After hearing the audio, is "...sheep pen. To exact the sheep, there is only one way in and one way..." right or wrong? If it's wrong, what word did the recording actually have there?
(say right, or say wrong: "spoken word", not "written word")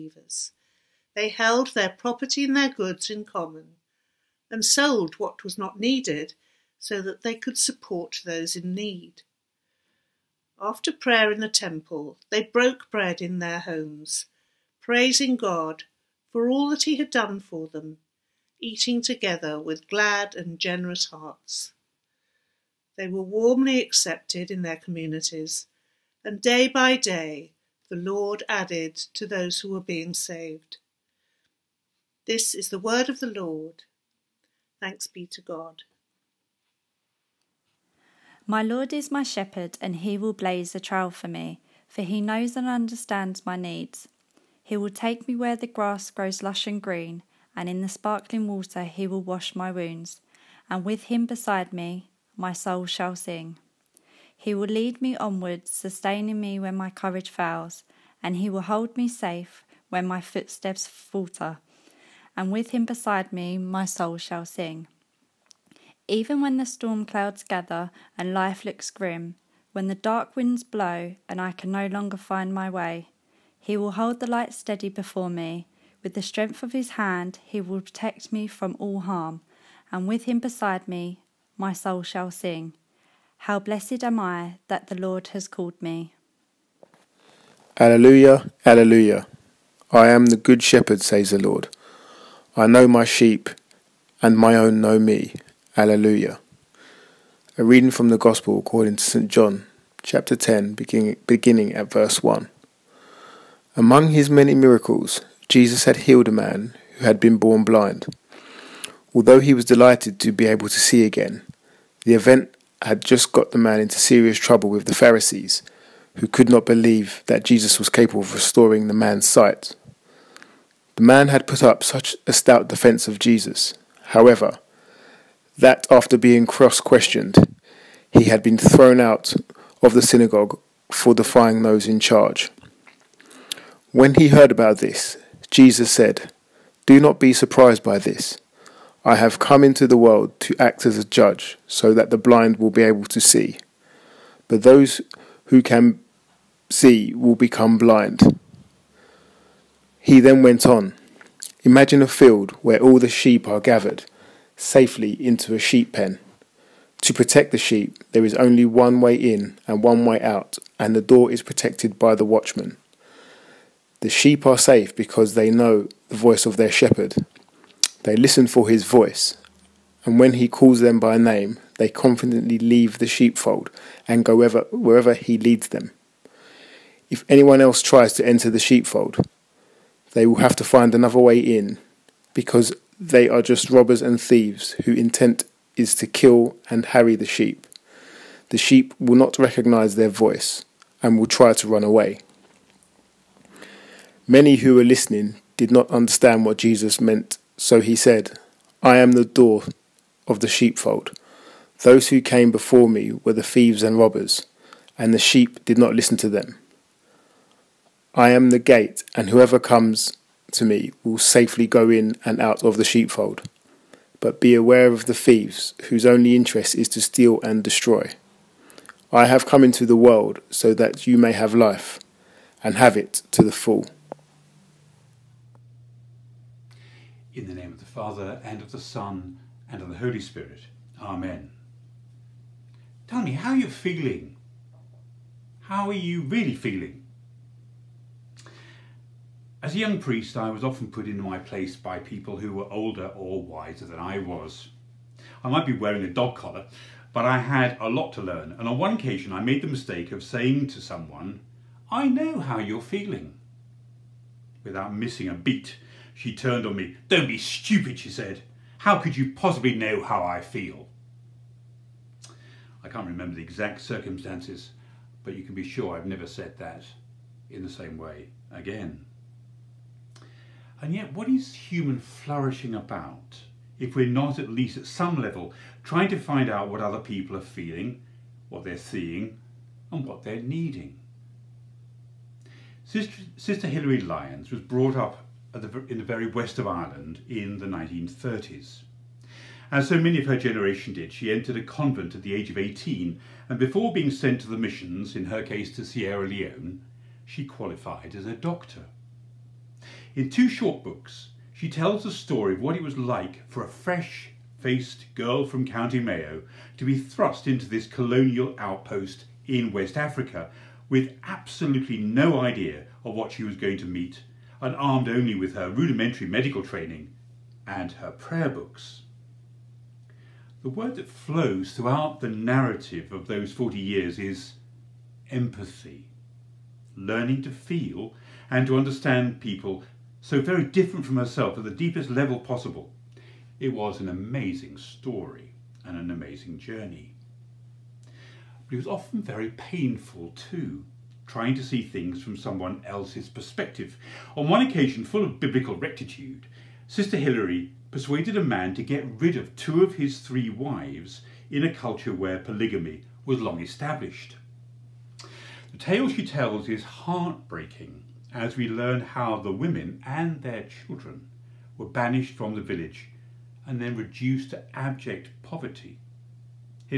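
wrong: "protect", not "exact".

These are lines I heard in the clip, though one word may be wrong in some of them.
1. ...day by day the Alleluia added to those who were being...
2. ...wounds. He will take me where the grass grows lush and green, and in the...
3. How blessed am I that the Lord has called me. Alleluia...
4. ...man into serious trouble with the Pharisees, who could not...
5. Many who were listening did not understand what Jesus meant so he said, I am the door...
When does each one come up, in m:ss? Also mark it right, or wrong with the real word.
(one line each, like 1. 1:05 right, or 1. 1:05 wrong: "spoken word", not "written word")
1. 0:26 wrong: "Lord", not "Alleluia"
2. 0:43 wrong: "needs", not "wounds"
3. 1:23 right
4. 1:53 right
5. 3:14 right.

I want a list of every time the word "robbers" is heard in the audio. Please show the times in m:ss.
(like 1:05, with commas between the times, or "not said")
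3:03, 3:23.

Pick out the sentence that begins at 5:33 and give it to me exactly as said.
It was an amazing story and an amazing journey.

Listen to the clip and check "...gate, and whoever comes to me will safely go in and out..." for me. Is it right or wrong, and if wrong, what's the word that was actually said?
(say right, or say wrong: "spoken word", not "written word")
right.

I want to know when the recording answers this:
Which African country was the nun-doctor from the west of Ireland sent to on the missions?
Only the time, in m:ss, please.
4:55.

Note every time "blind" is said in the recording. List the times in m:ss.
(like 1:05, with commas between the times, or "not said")
1:47, 2:22, 2:27.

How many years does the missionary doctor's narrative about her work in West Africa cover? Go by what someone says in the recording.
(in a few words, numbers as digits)
40.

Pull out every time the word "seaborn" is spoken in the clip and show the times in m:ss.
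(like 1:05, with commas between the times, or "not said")
not said.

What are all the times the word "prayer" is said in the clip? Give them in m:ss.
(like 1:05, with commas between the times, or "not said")
0:10, 5:18.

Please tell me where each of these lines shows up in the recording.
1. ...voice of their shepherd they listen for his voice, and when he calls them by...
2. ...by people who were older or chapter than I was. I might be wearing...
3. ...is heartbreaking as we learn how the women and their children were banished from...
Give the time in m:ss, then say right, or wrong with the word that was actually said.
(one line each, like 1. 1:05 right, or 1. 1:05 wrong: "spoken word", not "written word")
1. 2:46 right
2. 4:01 wrong: "wiser", not "chapter"
3. 5:56 right.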